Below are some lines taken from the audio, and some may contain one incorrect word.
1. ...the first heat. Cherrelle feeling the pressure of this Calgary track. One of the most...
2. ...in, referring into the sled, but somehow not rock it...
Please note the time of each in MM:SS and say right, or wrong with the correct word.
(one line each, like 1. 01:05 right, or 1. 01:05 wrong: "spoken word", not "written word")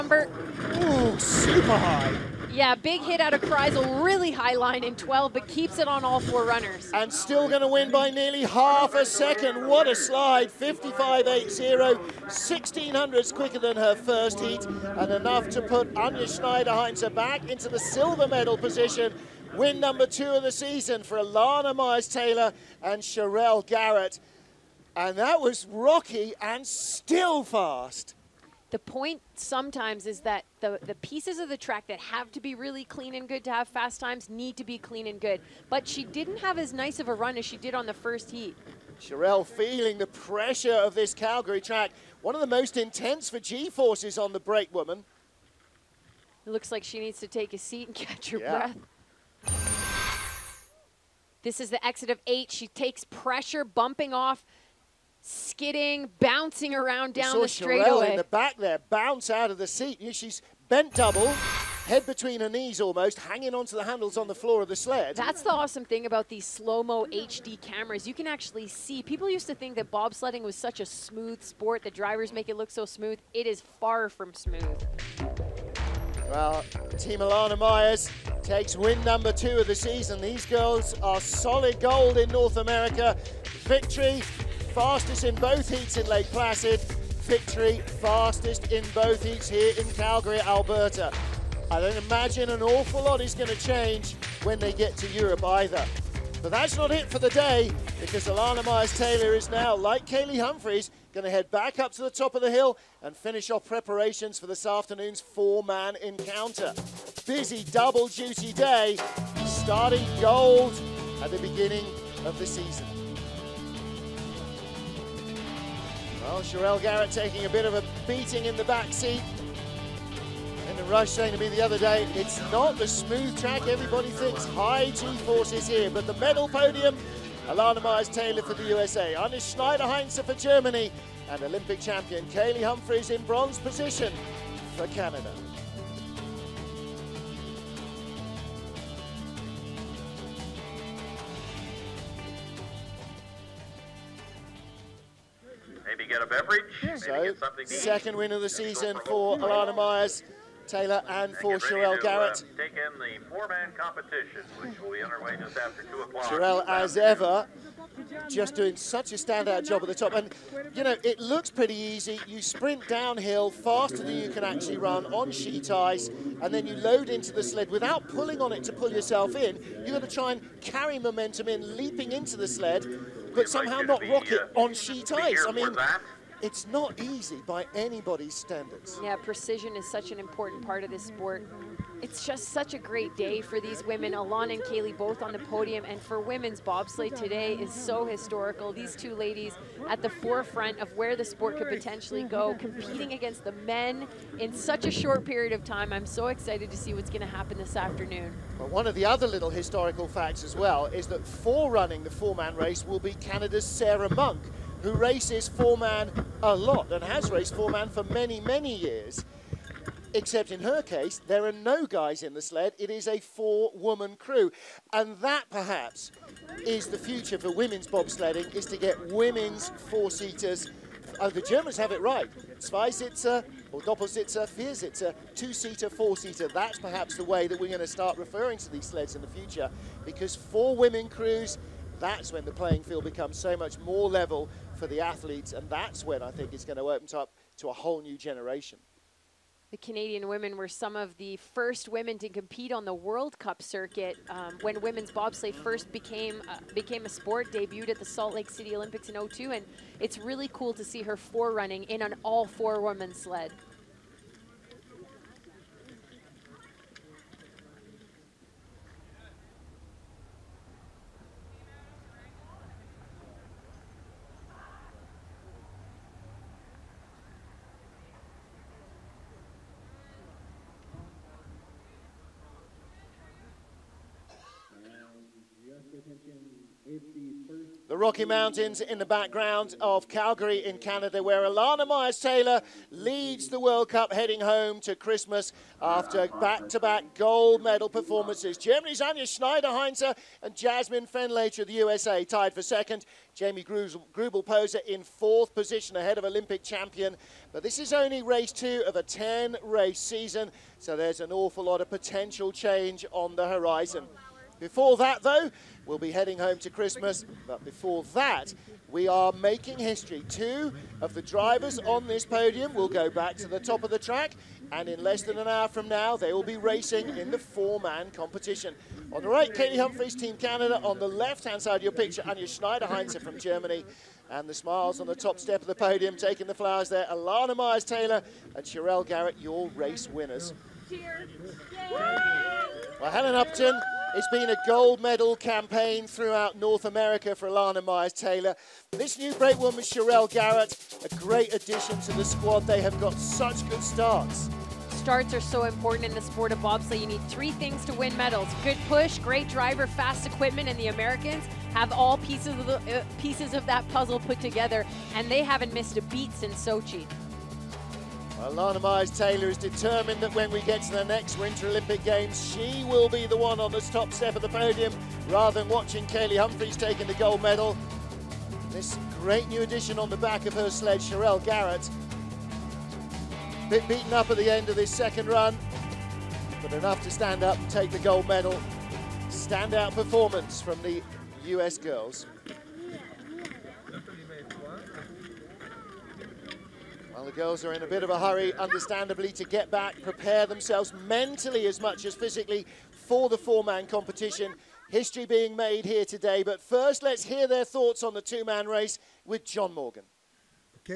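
1. 00:37 right
2. 02:51 wrong: "leaping", not "referring".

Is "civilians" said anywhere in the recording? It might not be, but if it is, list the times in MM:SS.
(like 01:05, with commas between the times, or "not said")
not said.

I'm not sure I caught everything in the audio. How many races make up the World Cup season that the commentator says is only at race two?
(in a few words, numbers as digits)
10.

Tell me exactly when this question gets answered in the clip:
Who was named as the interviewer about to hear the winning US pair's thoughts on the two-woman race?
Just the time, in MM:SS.
06:39.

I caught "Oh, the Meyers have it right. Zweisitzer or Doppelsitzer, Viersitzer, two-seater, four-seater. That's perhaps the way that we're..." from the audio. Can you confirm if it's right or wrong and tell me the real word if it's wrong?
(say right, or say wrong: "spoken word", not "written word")
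wrong: "Germans", not "Meyers".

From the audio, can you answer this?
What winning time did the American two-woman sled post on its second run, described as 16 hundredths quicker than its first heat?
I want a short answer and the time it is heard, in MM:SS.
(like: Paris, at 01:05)
55.80, at 00:10.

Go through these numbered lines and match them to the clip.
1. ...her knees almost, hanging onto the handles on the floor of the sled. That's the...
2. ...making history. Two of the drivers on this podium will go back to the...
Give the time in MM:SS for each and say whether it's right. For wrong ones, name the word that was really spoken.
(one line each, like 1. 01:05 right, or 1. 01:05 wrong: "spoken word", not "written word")
1. 01:02 right
2. 05:09 right.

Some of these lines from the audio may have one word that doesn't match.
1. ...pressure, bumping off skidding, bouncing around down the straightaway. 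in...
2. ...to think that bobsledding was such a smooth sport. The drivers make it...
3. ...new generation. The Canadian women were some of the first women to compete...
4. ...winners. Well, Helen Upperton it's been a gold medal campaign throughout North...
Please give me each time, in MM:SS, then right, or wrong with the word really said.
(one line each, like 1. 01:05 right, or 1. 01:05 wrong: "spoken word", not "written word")
1. 00:53 right
2. 01:09 right
3. 03:58 right
4. 05:30 right.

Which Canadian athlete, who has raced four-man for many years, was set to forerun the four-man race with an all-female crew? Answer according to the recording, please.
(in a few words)
Sarah Monk.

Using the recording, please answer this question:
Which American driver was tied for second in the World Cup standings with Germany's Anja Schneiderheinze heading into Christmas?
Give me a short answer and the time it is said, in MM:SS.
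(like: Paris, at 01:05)
Jazmine Fenlator, at 04:50.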